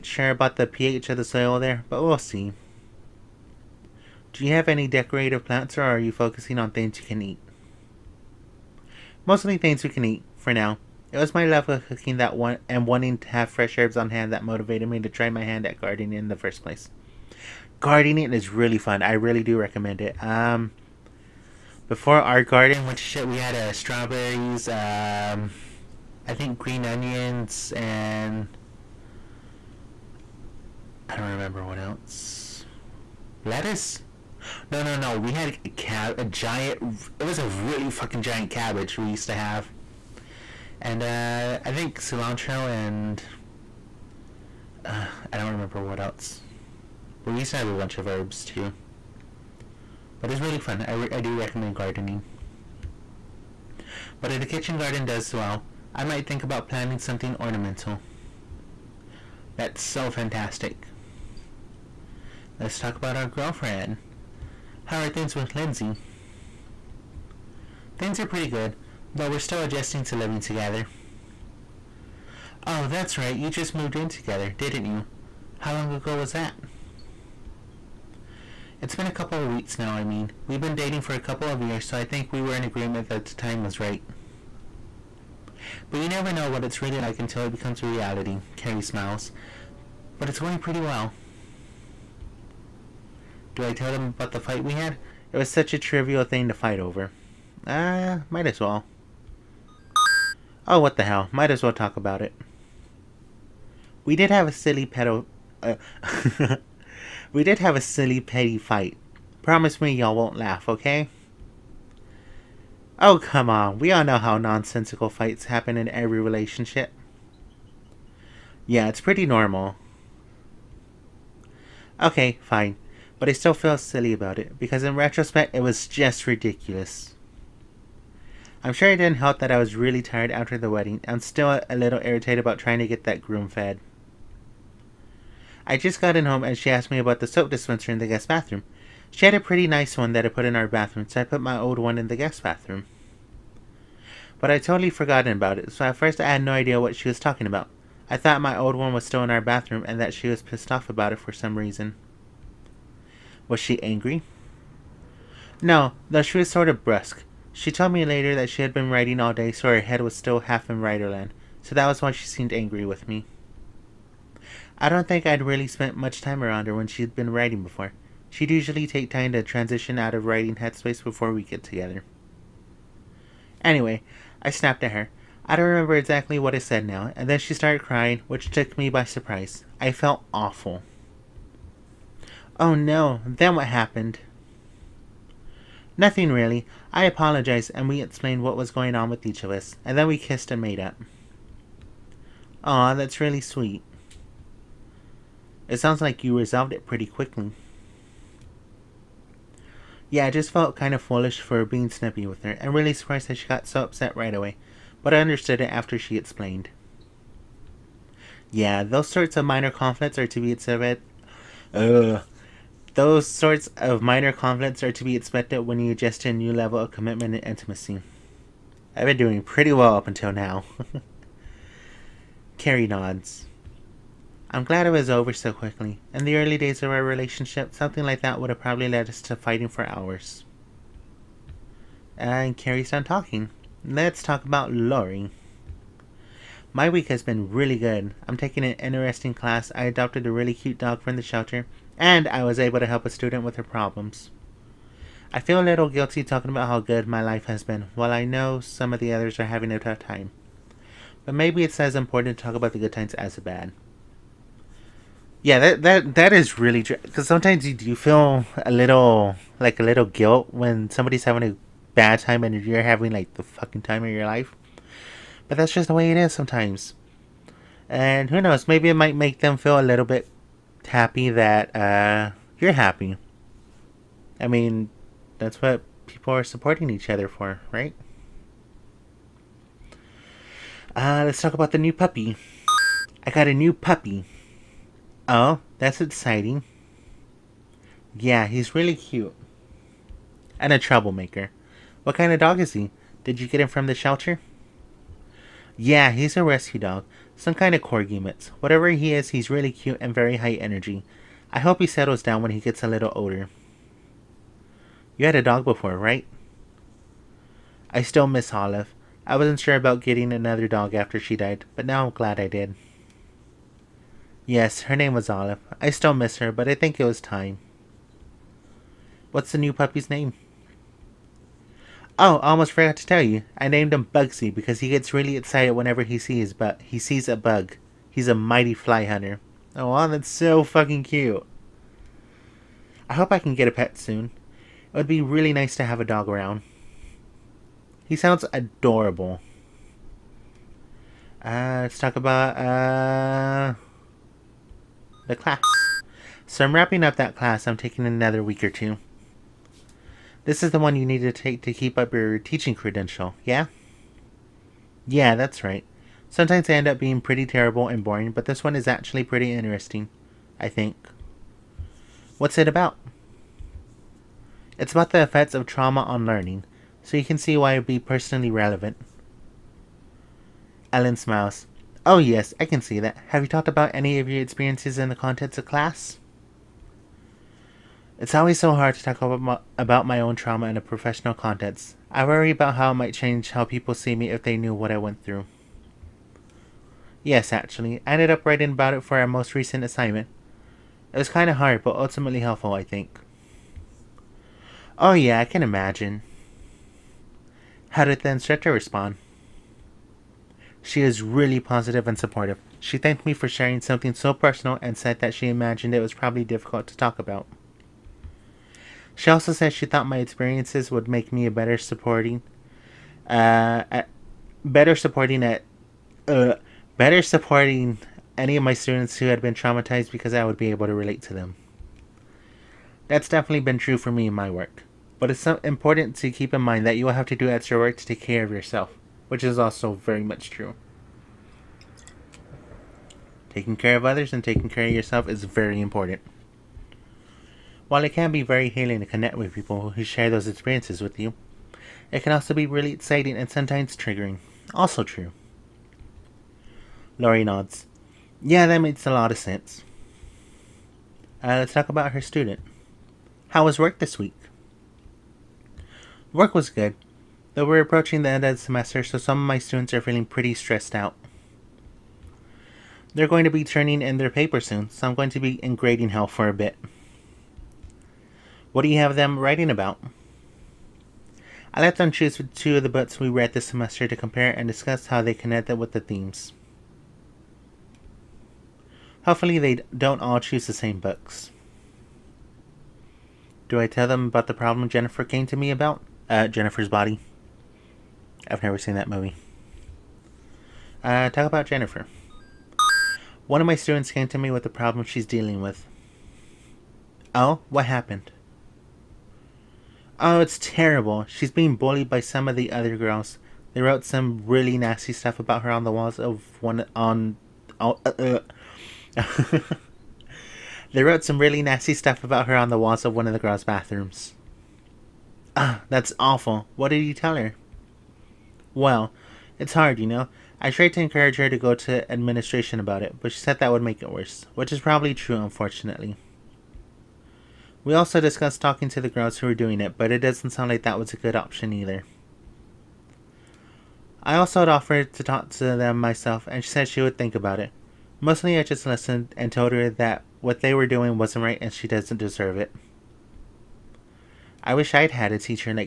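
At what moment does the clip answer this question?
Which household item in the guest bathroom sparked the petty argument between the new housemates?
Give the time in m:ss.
2:17.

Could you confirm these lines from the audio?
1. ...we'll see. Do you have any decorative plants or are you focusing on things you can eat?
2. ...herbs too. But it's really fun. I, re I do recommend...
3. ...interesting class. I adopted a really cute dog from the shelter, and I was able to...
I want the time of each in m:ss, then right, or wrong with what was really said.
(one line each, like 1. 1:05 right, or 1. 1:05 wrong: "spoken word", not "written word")
1. 0:02 right
2. 0:48 right
3. 3:58 right.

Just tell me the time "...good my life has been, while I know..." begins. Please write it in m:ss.
4:06.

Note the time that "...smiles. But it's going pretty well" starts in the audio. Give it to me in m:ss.
1:28.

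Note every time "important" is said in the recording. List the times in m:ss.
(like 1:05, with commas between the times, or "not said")
4:11, 7:05, 7:15.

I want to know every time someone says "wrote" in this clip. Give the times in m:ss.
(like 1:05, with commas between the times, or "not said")
8:23, 8:31.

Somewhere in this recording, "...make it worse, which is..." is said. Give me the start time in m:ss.
8:43.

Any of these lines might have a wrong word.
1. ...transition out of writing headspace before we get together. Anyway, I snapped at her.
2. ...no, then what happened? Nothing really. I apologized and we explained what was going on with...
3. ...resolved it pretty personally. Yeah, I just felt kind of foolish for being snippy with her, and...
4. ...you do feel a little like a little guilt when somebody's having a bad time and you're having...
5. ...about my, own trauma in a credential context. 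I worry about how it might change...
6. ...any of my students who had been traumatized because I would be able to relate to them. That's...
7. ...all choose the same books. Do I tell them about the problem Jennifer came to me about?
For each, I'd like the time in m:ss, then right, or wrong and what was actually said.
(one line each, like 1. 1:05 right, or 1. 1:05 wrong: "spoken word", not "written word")
1. 2:49 right
2. 3:02 right
3. 3:16 wrong: "quickly", not "personally"
4. 4:17 right
5. 6:19 wrong: "professional", not "credential"
6. 6:58 right
7. 8:00 right.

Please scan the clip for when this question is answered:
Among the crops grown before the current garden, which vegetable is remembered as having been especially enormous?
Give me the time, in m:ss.
0:38.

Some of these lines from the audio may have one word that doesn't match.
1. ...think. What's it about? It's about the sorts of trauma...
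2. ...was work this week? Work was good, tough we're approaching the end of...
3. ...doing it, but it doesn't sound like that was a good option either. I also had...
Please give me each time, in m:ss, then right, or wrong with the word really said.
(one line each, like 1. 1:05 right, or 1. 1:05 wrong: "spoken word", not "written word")
1. 6:00 wrong: "effects", not "sorts"
2. 7:33 wrong: "though", not "tough"
3. 8:49 right.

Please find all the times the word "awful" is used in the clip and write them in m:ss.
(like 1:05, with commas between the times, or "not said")
3:00, 8:36.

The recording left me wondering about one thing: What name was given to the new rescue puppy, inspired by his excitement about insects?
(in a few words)
Bugsy.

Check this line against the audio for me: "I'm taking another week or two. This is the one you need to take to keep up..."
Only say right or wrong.
right.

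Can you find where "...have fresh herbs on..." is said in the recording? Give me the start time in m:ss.
0:13.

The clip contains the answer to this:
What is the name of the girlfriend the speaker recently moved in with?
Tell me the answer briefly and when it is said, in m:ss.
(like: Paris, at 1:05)
Lindsay, at 1:05.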